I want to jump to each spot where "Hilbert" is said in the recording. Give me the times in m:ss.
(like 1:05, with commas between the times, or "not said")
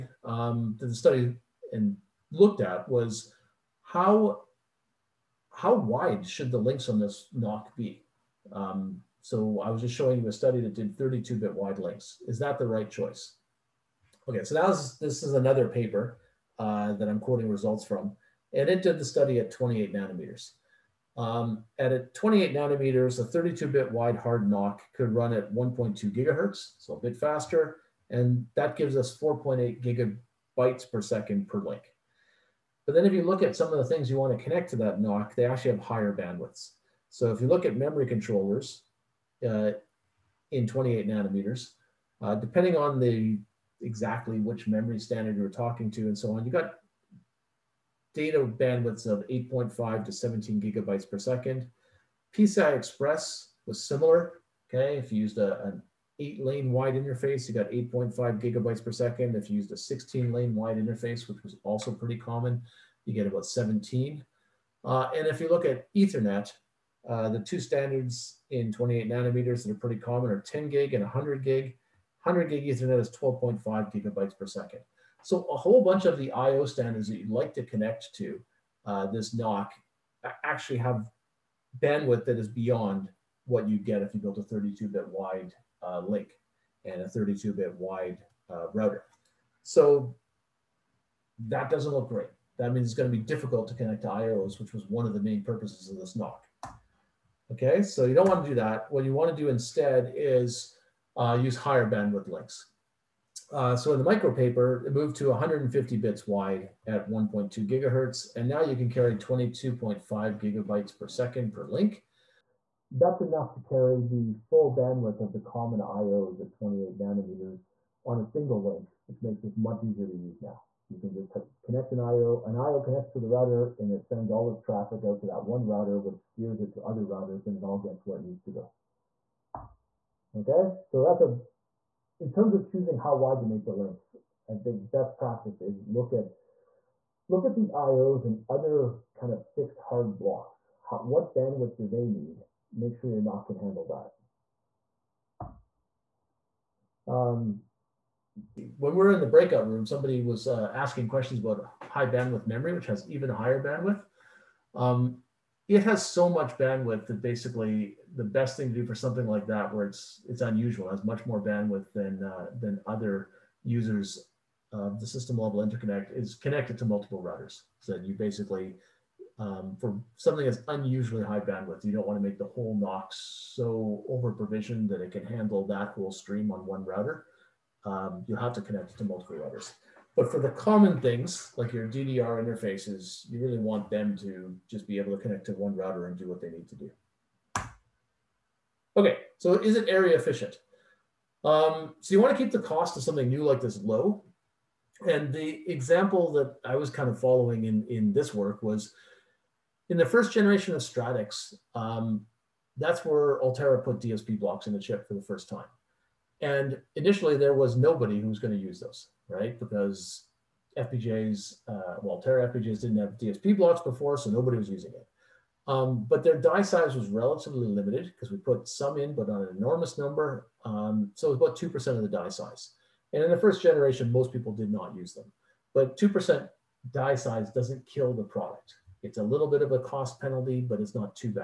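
not said.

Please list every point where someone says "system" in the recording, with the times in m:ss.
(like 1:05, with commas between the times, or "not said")
2:45.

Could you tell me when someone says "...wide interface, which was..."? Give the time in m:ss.
1:00.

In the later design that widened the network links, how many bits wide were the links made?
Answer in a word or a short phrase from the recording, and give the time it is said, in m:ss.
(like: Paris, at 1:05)
150 bits, at 1:45.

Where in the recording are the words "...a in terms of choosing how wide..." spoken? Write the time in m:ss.
2:11.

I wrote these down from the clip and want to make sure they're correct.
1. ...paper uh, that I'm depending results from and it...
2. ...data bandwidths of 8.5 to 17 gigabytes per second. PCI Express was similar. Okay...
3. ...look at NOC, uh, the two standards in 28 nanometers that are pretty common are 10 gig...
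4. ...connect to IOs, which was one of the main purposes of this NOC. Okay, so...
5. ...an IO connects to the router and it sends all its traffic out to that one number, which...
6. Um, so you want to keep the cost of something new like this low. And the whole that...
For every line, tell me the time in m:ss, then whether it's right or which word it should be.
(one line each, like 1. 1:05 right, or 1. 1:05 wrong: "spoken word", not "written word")
1. 0:15 wrong: "quoting", not "depending"
2. 0:48 right
3. 1:05 wrong: "Ethernet", not "NOC"
4. 1:33 right
5. 2:02 wrong: "router", not "number"
6. 3:11 wrong: "example", not "whole".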